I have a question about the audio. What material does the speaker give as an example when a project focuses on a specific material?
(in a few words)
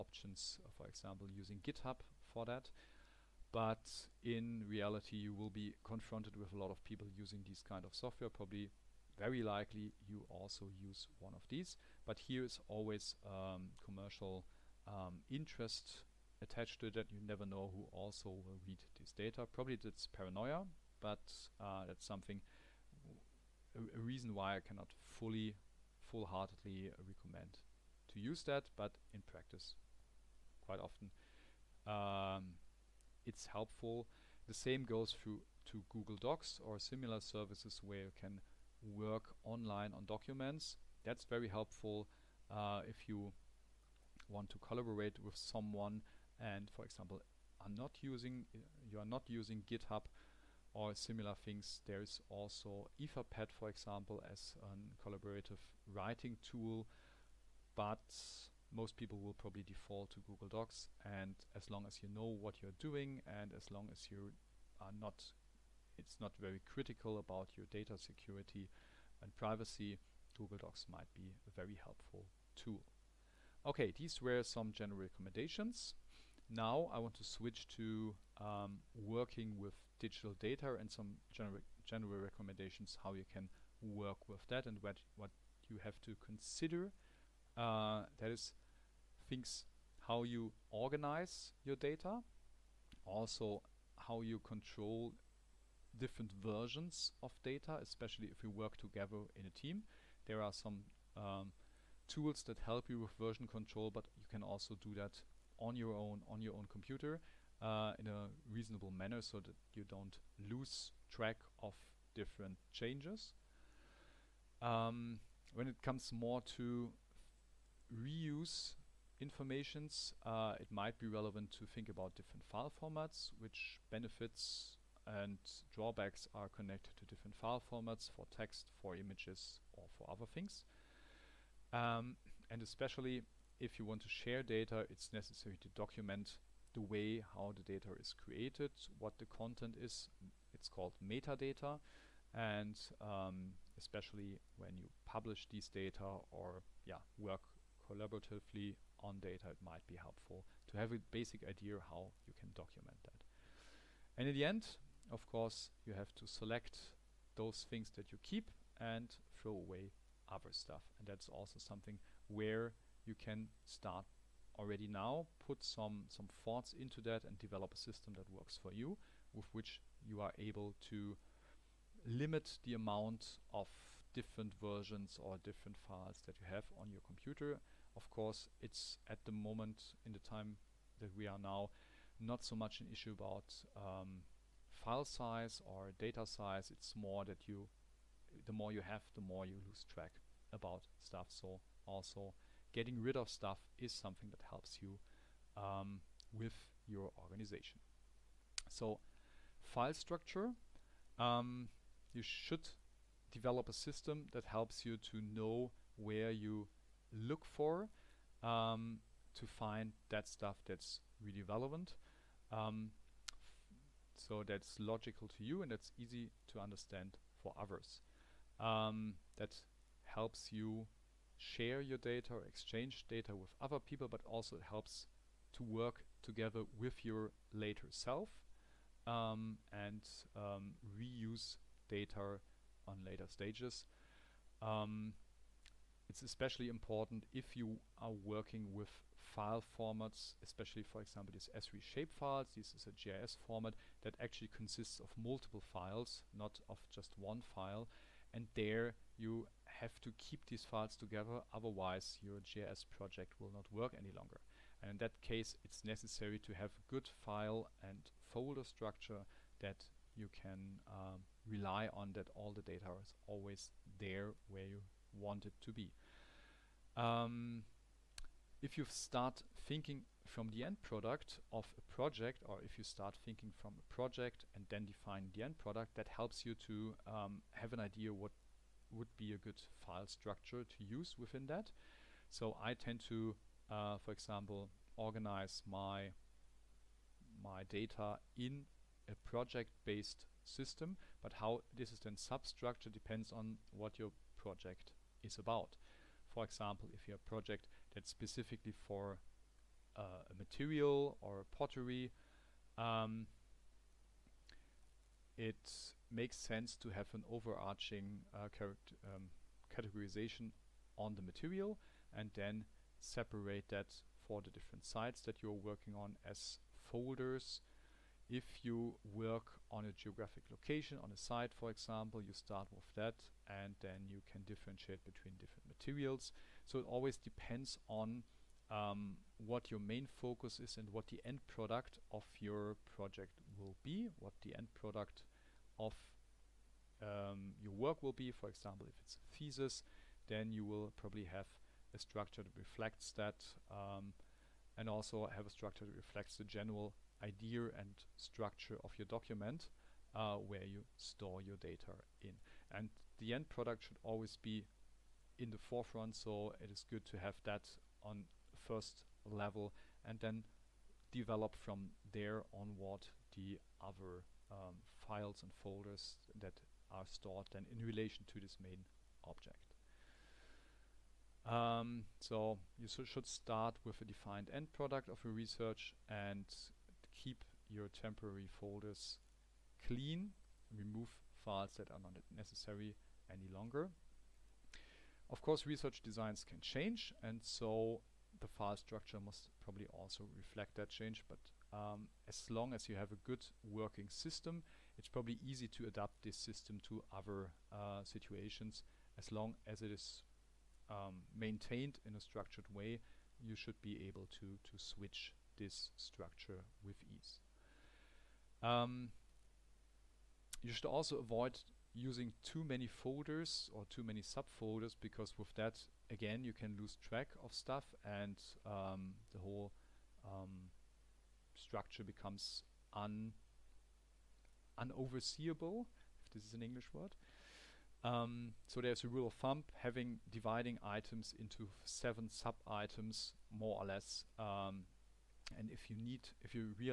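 pottery.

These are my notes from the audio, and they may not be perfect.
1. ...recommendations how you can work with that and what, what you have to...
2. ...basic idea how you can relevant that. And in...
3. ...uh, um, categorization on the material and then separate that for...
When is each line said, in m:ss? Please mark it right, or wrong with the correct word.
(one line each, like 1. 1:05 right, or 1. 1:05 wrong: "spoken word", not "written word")
1. 1:22 right
2. 2:31 wrong: "document", not "relevant"
3. 5:08 right.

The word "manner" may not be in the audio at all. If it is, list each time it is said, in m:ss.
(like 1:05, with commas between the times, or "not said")
1:48.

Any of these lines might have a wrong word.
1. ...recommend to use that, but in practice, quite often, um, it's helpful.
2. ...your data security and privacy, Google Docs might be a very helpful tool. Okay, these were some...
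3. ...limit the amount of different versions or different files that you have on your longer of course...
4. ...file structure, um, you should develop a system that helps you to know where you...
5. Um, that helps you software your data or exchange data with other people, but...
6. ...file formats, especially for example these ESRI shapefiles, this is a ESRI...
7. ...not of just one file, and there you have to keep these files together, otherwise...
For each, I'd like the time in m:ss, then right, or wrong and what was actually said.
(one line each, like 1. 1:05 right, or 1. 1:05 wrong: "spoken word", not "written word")
1. 0:27 right
2. 1:07 right
3. 2:52 wrong: "computer", not "longer"
4. 3:19 right
5. 3:38 wrong: "share", not "software"
6. 3:59 wrong: "GIS", not "ESRI"
7. 4:06 right.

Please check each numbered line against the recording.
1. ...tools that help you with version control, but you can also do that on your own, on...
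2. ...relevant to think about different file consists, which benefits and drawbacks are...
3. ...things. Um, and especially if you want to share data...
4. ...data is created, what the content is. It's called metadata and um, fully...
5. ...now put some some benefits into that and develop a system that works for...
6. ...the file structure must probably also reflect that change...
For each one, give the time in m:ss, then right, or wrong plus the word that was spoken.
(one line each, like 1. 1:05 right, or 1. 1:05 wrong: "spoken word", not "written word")
1. 1:42 right
2. 2:01 wrong: "formats", not "consists"
3. 2:10 right
4. 2:17 wrong: "especially", not "fully"
5. 2:44 wrong: "thoughts", not "benefits"
6. 6:28 right.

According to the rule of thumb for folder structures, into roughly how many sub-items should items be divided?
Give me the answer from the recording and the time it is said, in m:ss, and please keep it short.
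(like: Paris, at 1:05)
7, at 7:11.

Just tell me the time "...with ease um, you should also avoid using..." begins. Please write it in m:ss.
6:46.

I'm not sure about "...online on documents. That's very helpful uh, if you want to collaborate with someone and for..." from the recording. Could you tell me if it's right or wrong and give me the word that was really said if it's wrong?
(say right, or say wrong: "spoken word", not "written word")
right.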